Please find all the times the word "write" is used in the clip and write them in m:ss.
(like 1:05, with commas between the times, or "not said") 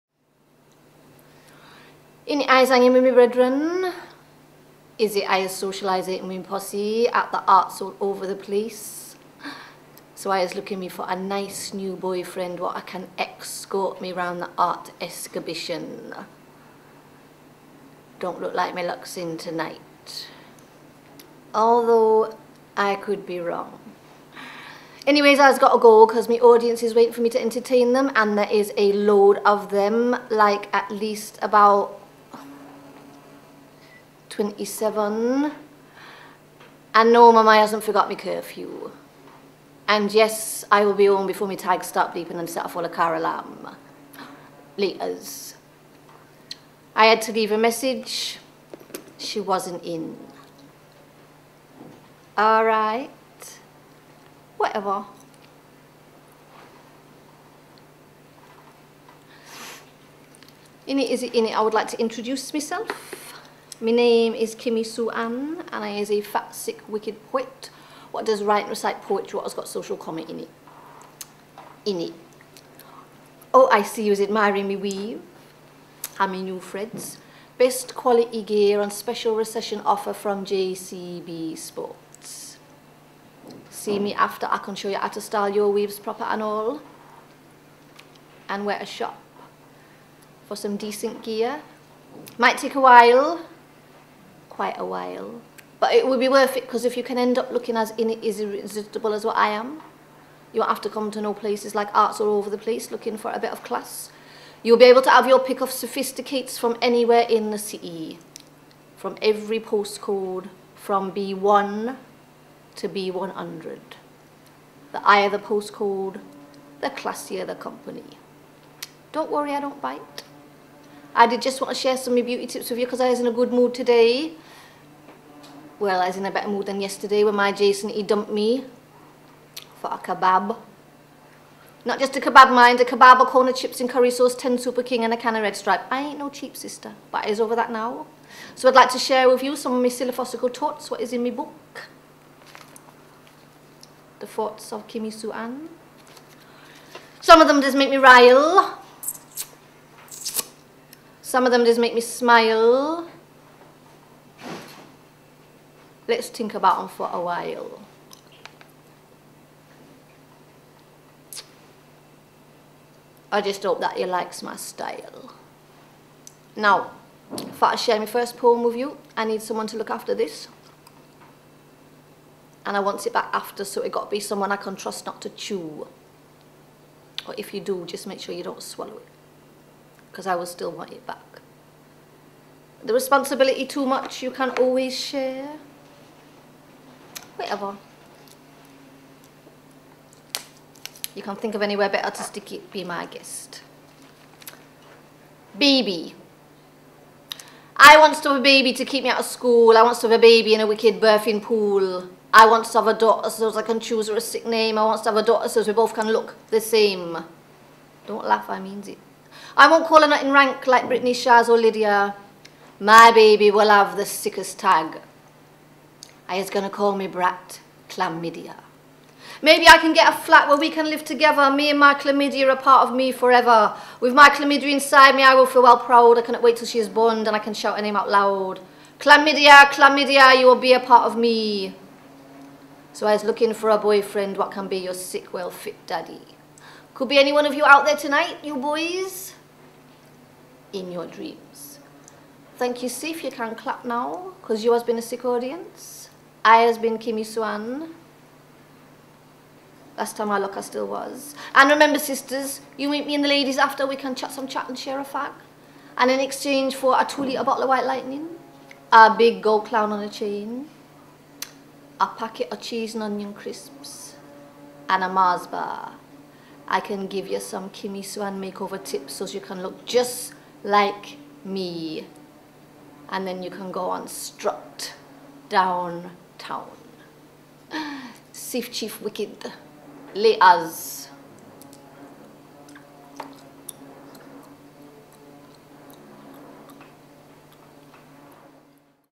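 1:08.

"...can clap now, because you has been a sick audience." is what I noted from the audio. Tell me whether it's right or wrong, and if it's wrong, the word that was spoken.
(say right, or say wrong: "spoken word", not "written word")
right.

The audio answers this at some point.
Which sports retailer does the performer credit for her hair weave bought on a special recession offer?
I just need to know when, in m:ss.
1:20.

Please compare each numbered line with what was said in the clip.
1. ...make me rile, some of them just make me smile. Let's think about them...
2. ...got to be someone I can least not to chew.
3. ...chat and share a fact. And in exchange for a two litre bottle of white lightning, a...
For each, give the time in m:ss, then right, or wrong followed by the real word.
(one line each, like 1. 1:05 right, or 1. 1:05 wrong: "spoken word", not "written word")
1. 2:27 right
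2. 2:53 wrong: "trust", not "least"
3. 4:14 right.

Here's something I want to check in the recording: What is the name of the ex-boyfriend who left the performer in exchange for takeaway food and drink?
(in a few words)
Jason.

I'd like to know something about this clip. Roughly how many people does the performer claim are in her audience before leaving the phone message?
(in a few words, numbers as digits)
27.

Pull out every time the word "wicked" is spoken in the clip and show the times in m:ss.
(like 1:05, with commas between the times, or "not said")
1:06, 3:20, 4:39.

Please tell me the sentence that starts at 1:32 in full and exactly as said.
Might take a while, quite a while.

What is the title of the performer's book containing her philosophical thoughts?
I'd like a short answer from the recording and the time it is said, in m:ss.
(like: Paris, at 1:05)
The Thoughts of Kimmy Sue Anne, at 2:24.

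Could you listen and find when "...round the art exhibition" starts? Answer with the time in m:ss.
0:14.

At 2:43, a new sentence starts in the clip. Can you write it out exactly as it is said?
I just hope that he likes my style.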